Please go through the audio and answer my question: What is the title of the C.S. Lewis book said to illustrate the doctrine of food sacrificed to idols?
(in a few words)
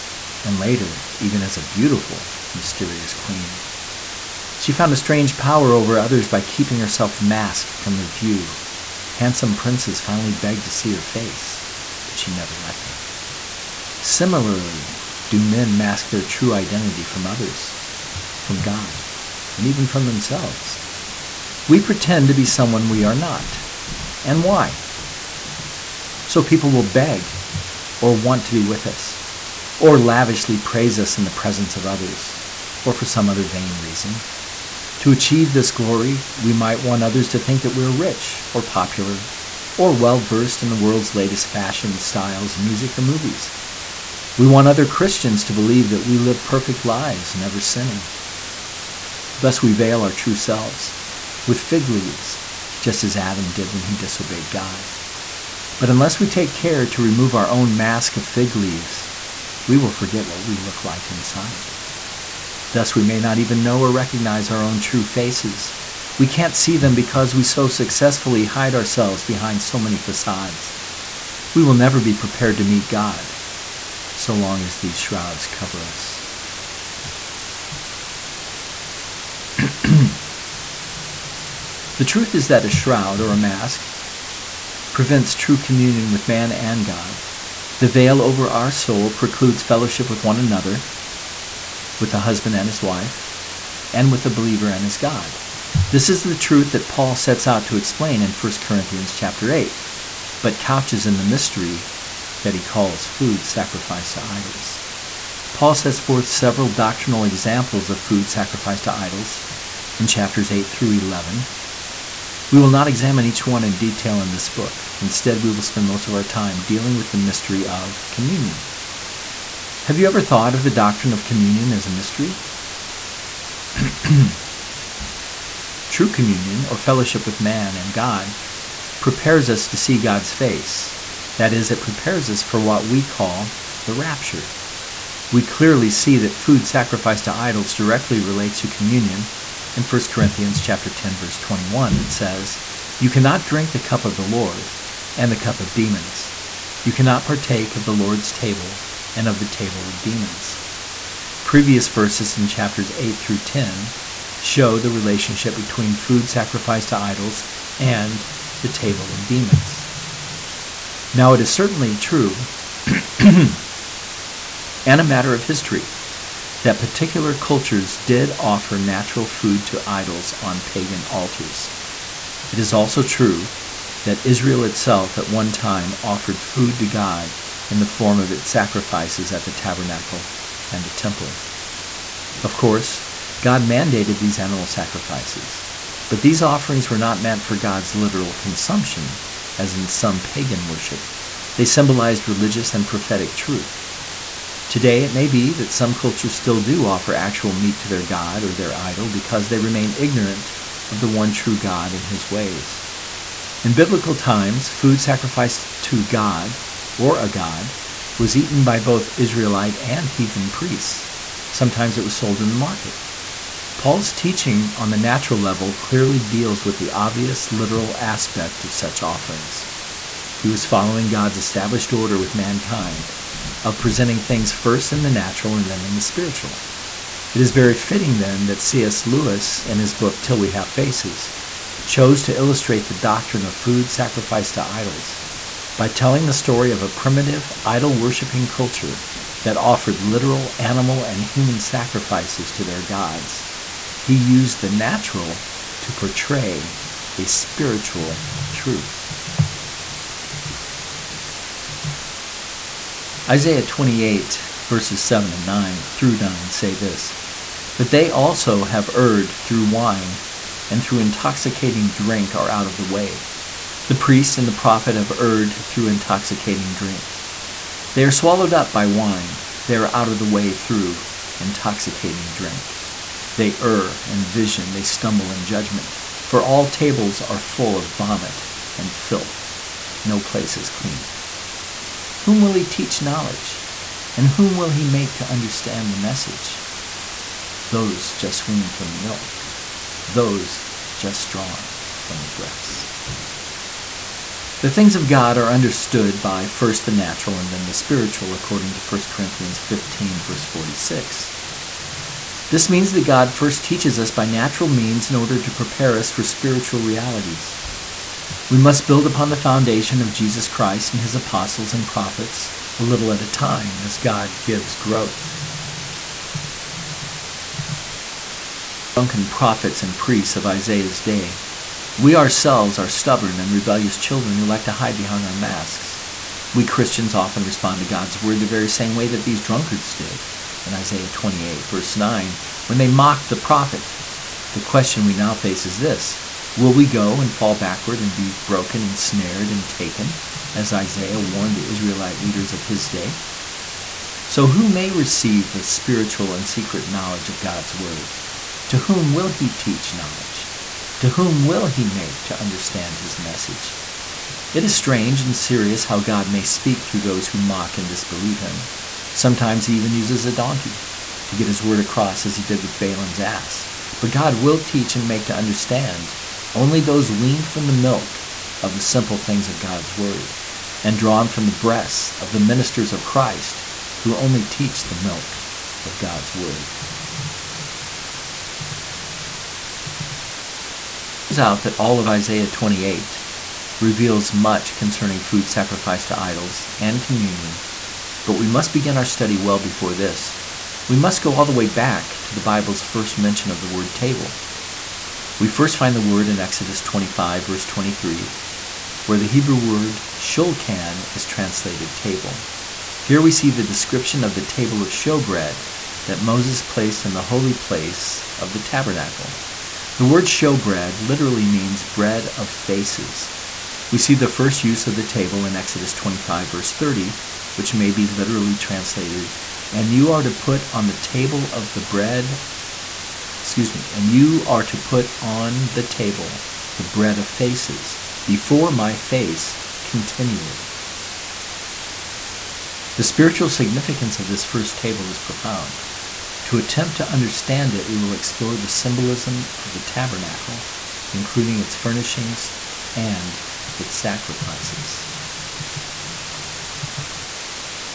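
Till We Have Faces.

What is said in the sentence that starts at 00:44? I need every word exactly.
We want other Christians to believe that we live perfect lives, never sinning.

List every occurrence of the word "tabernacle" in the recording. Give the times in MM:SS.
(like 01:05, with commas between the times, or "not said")
02:59, 06:48, 07:19.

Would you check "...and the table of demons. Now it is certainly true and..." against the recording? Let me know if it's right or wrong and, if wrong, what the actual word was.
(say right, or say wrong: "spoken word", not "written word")
right.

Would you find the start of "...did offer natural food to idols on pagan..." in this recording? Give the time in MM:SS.
02:47.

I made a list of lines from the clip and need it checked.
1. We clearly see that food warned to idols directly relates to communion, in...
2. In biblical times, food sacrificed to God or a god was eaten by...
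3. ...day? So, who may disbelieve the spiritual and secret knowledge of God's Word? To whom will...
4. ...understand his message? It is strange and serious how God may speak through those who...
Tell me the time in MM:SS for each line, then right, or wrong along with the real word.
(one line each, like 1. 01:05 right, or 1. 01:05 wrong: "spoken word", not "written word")
1. 02:15 wrong: "sacrificed", not "warned"
2. 03:23 right
3. 05:42 wrong: "receive", not "disbelieve"
4. 05:52 right.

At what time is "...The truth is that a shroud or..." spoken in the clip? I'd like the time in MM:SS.
01:21.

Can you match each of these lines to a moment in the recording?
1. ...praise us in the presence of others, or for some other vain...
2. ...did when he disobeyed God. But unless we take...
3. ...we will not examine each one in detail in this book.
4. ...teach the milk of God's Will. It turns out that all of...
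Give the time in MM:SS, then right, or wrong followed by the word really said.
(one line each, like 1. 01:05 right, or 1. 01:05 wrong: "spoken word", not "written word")
1. 00:30 right
2. 00:53 right
3. 01:52 right
4. 06:14 wrong: "Word", not "Will".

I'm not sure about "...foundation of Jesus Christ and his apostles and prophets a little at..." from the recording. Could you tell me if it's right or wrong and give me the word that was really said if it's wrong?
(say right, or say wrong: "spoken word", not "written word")
right.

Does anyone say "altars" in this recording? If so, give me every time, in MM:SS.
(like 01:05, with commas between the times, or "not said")
02:51.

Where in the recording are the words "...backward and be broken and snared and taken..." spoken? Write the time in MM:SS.
05:37.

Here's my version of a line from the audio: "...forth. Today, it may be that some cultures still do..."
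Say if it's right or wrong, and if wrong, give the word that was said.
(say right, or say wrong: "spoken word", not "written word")
wrong: "truth", not "forth".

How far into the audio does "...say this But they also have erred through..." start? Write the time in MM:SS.
04:16.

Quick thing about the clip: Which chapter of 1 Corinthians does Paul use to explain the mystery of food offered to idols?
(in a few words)
8.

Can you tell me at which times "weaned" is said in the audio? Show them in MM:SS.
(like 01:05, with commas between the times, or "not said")
04:48, 06:07.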